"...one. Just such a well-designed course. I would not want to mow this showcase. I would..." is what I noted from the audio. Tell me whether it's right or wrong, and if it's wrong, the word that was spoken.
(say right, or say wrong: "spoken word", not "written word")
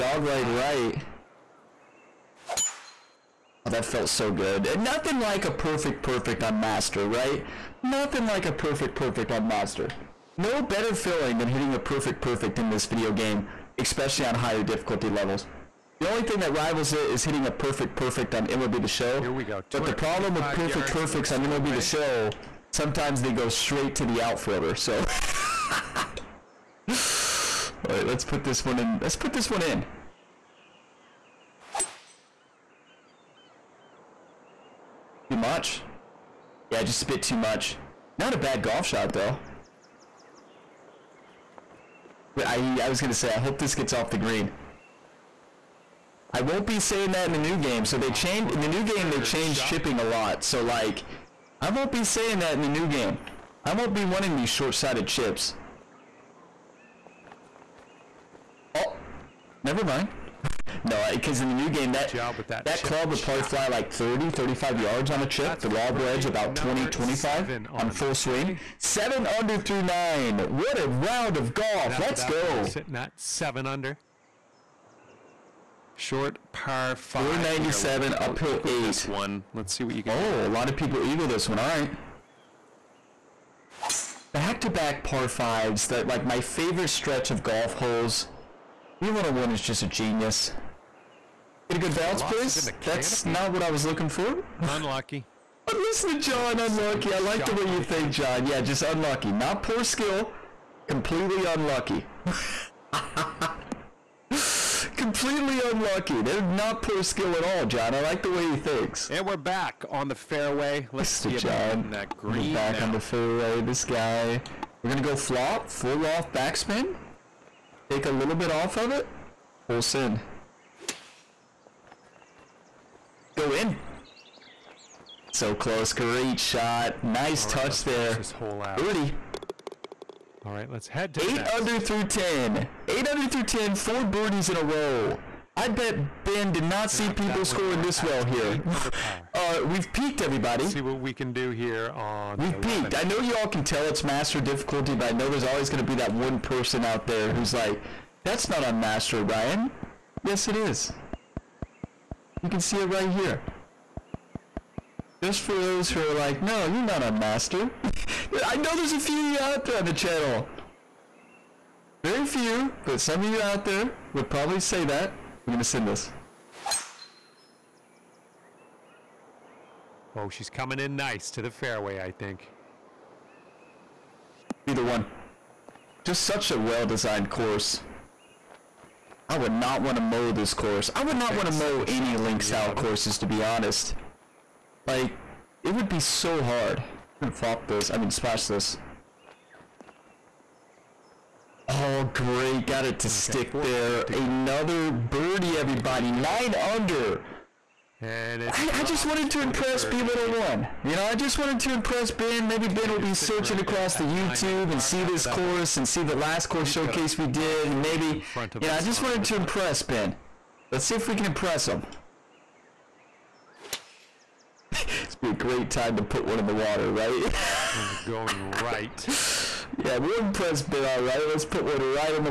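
wrong: "course", not "showcase".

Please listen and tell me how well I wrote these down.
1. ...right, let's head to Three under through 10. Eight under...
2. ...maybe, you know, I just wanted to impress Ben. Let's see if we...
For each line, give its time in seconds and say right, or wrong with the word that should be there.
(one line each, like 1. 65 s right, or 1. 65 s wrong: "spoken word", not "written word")
1. 130 s wrong: "Eight", not "Three"
2. 207 s right.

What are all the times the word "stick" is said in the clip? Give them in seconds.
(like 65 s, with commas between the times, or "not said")
193 s.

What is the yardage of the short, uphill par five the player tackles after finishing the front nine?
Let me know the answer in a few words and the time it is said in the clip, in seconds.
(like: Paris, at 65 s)
497, at 77 s.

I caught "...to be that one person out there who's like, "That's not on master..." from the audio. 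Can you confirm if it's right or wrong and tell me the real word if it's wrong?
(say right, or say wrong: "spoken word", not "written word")
right.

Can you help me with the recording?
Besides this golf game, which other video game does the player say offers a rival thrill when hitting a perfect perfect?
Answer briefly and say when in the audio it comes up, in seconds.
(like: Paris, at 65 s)
MLB The Show, at 18 s.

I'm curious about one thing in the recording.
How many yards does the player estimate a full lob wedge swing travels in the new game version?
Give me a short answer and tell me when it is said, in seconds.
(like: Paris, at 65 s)
20, 25, at 66 s.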